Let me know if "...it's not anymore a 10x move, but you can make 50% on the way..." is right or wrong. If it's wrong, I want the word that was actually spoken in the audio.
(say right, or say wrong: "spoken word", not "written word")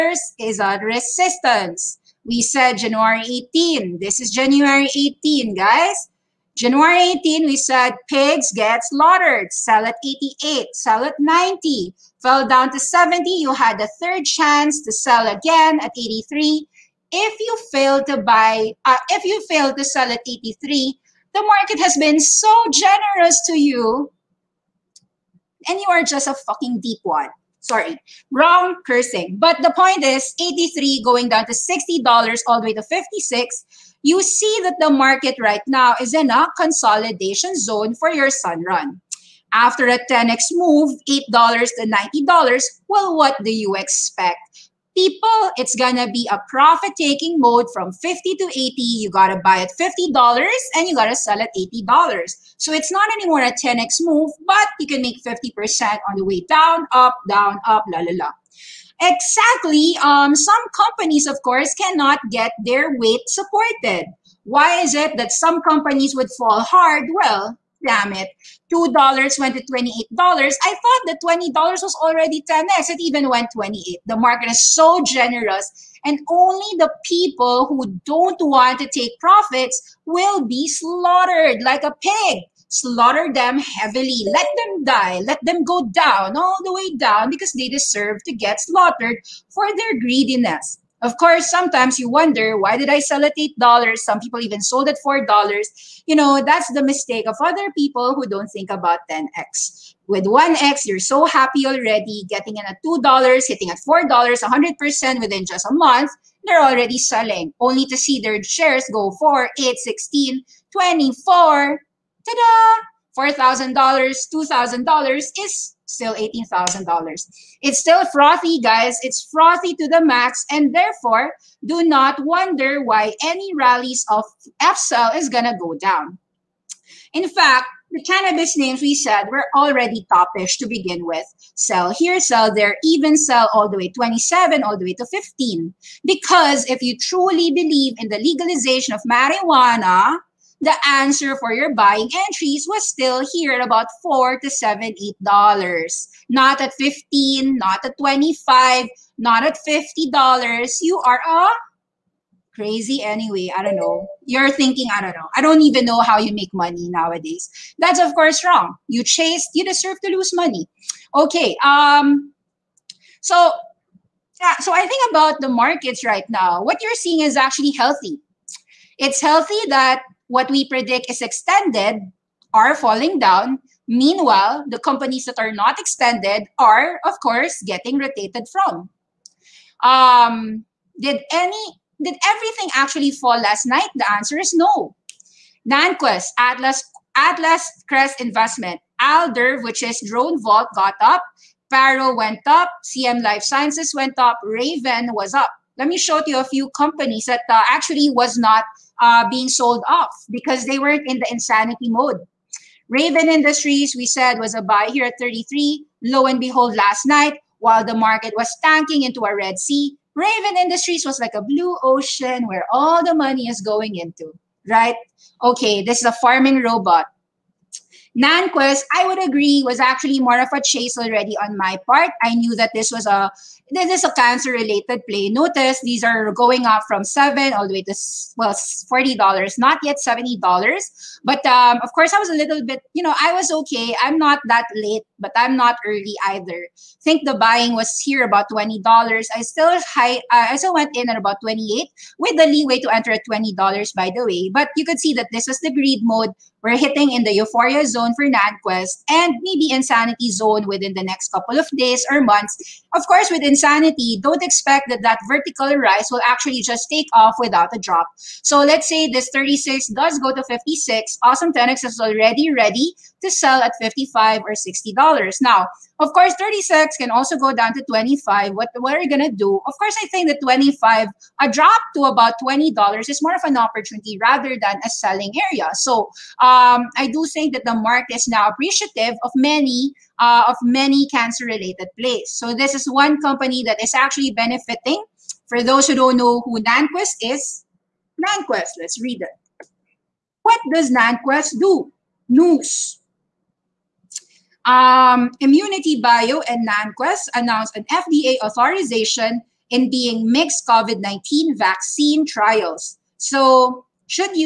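right.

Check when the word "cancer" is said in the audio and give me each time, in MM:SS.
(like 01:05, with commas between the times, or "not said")
03:44, 04:41.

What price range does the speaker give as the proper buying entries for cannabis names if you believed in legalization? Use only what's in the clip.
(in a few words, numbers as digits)
4 to 8 dollars.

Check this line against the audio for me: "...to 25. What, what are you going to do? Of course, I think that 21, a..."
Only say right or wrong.
wrong.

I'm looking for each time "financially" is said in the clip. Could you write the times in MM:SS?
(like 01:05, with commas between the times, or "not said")
not said.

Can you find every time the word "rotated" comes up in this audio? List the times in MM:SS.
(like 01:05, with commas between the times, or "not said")
02:57.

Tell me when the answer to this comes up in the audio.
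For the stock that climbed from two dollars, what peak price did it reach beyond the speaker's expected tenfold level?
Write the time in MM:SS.
01:12.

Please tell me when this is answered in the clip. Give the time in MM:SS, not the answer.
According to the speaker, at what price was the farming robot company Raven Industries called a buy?
03:24.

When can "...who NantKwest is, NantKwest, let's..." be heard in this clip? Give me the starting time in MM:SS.
04:46.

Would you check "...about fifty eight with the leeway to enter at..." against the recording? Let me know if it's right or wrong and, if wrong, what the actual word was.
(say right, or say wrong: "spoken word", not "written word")
wrong: "twenty", not "fifty".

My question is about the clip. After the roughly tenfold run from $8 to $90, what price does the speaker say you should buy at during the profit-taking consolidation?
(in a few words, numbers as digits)
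$50.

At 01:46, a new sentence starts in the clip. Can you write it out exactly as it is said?
They're already selling, only to see their shares go 4, 8, 16, 24.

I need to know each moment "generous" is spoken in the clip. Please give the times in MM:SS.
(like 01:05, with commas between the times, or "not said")
00:22, 01:15.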